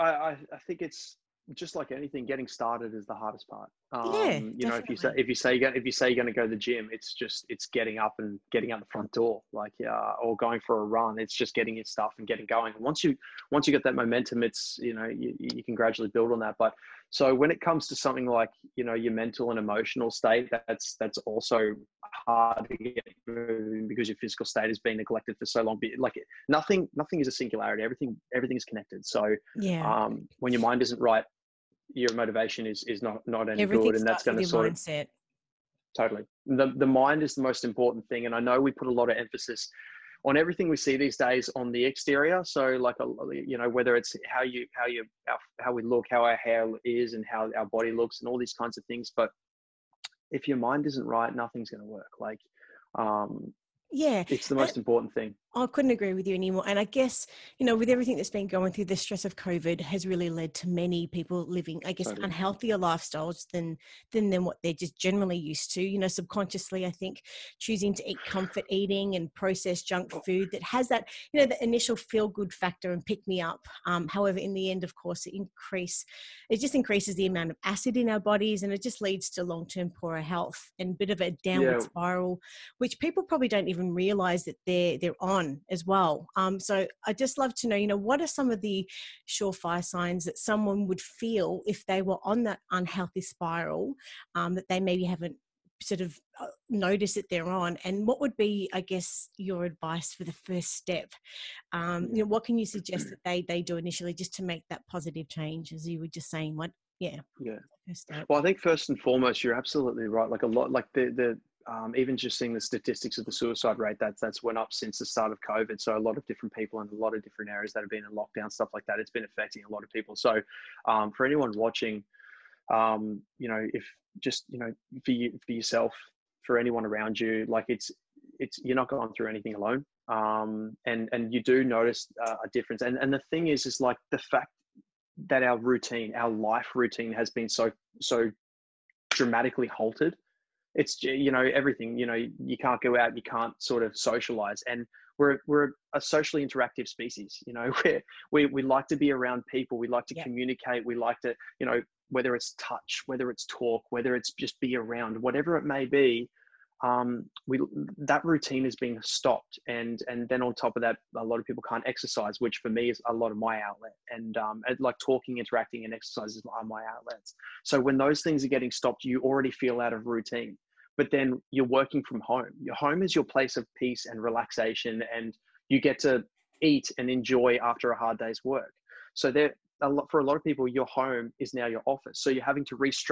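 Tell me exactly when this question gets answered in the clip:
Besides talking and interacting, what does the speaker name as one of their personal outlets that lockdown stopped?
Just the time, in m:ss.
2:45.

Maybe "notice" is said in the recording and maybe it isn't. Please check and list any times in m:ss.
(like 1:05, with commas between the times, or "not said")
1:36, 2:11.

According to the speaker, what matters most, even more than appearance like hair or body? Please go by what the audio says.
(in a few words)
the mind.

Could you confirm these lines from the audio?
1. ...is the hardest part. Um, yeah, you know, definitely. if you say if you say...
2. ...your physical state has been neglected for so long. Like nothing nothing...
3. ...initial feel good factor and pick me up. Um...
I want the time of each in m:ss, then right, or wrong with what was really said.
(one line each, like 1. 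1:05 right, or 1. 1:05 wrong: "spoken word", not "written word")
1. 0:02 right
2. 0:24 right
3. 1:11 right.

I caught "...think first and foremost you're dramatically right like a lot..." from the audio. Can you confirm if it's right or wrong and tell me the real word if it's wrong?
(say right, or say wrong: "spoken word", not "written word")
wrong: "absolutely", not "dramatically".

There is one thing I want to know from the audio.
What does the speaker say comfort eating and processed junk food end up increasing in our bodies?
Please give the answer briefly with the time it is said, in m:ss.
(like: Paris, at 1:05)
acid, at 1:17.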